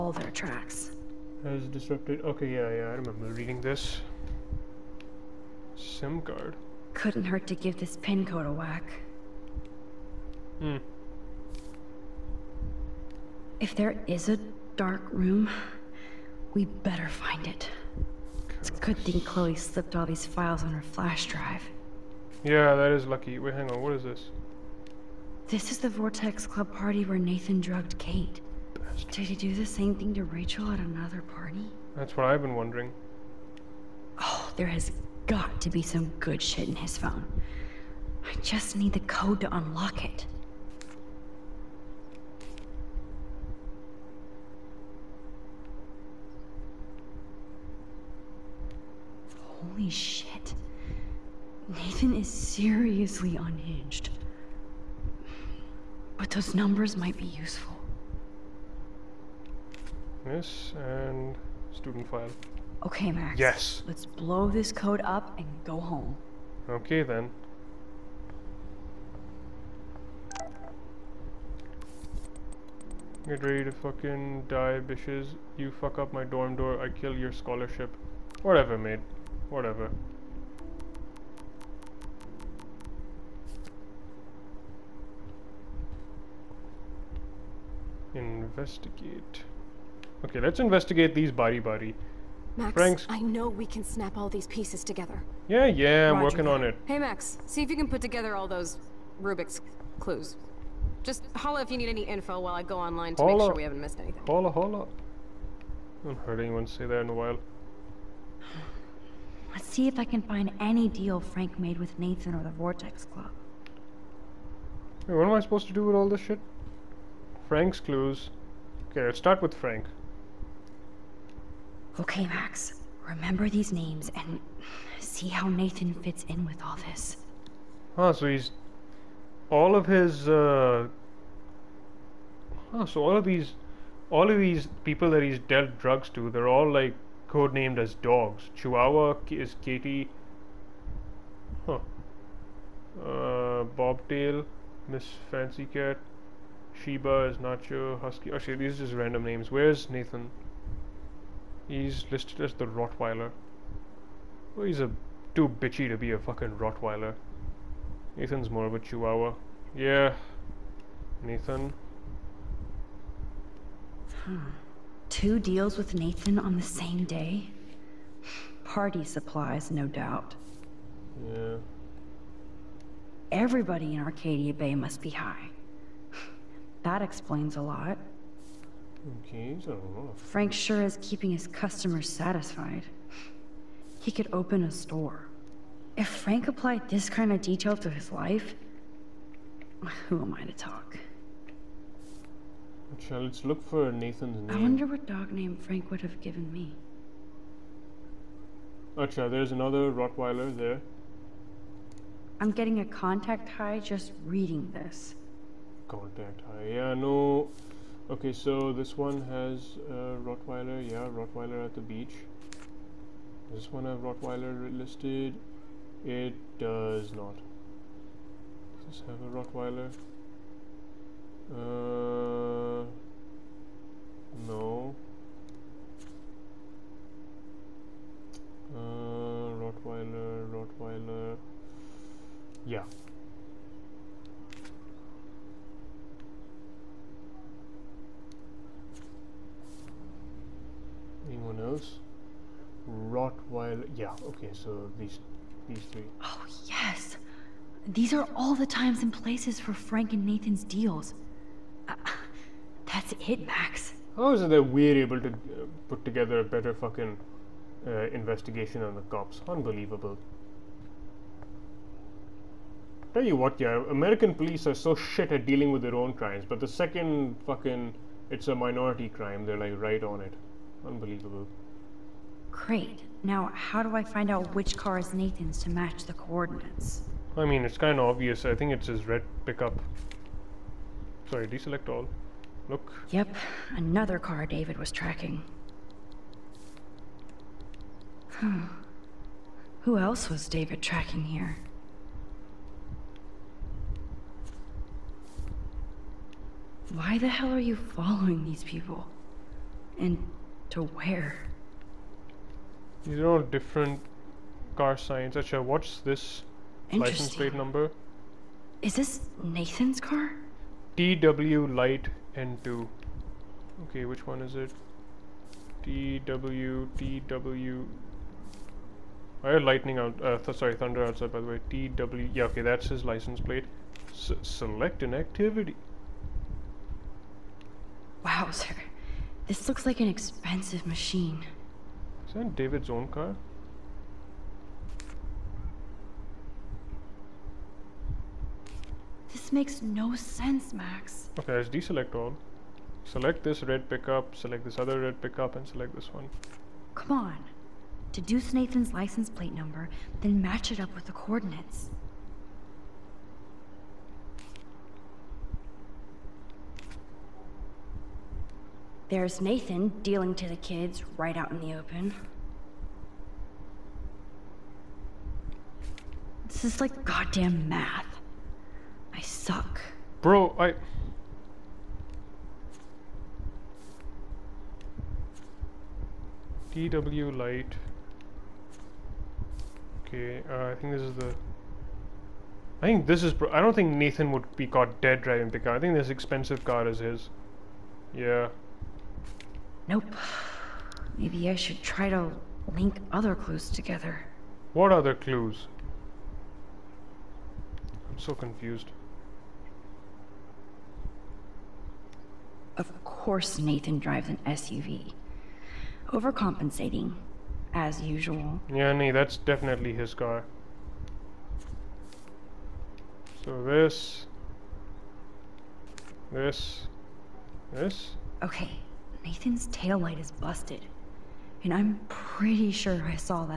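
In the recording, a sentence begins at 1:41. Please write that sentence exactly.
Just holla if you need any info while I go online to holla.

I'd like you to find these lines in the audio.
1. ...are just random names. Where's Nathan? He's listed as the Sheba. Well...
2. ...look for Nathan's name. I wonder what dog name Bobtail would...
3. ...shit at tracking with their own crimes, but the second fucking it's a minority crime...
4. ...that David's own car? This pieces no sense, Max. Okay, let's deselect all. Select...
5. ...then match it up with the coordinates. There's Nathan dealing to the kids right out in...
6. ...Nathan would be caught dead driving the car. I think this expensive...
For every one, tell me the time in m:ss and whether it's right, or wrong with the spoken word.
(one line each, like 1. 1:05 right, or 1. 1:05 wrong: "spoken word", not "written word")
1. 2:28 wrong: "Rottweiler", not "Sheba"
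2. 3:13 wrong: "Frank", not "Bobtail"
3. 4:24 wrong: "dealing", not "tracking"
4. 5:32 wrong: "makes", not "pieces"
5. 5:50 right
6. 6:23 right.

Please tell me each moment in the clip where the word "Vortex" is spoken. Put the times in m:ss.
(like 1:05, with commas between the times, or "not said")
0:25, 1:52.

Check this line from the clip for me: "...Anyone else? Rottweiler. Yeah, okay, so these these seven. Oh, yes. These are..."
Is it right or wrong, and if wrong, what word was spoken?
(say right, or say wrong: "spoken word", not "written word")
wrong: "three", not "seven".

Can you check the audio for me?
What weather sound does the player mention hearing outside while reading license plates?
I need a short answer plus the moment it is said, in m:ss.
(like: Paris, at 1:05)
thunder, at 5:20.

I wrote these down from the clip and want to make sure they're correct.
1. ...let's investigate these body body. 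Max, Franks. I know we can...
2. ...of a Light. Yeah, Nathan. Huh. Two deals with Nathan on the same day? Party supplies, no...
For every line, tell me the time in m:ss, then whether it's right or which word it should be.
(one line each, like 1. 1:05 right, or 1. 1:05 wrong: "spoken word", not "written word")
1. 1:30 right
2. 2:38 wrong: "Chihuahua", not "Light".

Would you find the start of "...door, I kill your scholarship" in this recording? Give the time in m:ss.
1:16.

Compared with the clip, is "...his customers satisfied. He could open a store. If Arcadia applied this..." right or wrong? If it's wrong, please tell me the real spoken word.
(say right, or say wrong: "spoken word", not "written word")
wrong: "Frank", not "Arcadia".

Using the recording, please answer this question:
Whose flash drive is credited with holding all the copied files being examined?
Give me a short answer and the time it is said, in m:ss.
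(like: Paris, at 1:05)
Chloe, at 0:19.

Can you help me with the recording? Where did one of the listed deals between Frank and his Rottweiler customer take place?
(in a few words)
the beach.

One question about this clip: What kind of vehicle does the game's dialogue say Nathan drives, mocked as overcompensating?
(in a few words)
SUV.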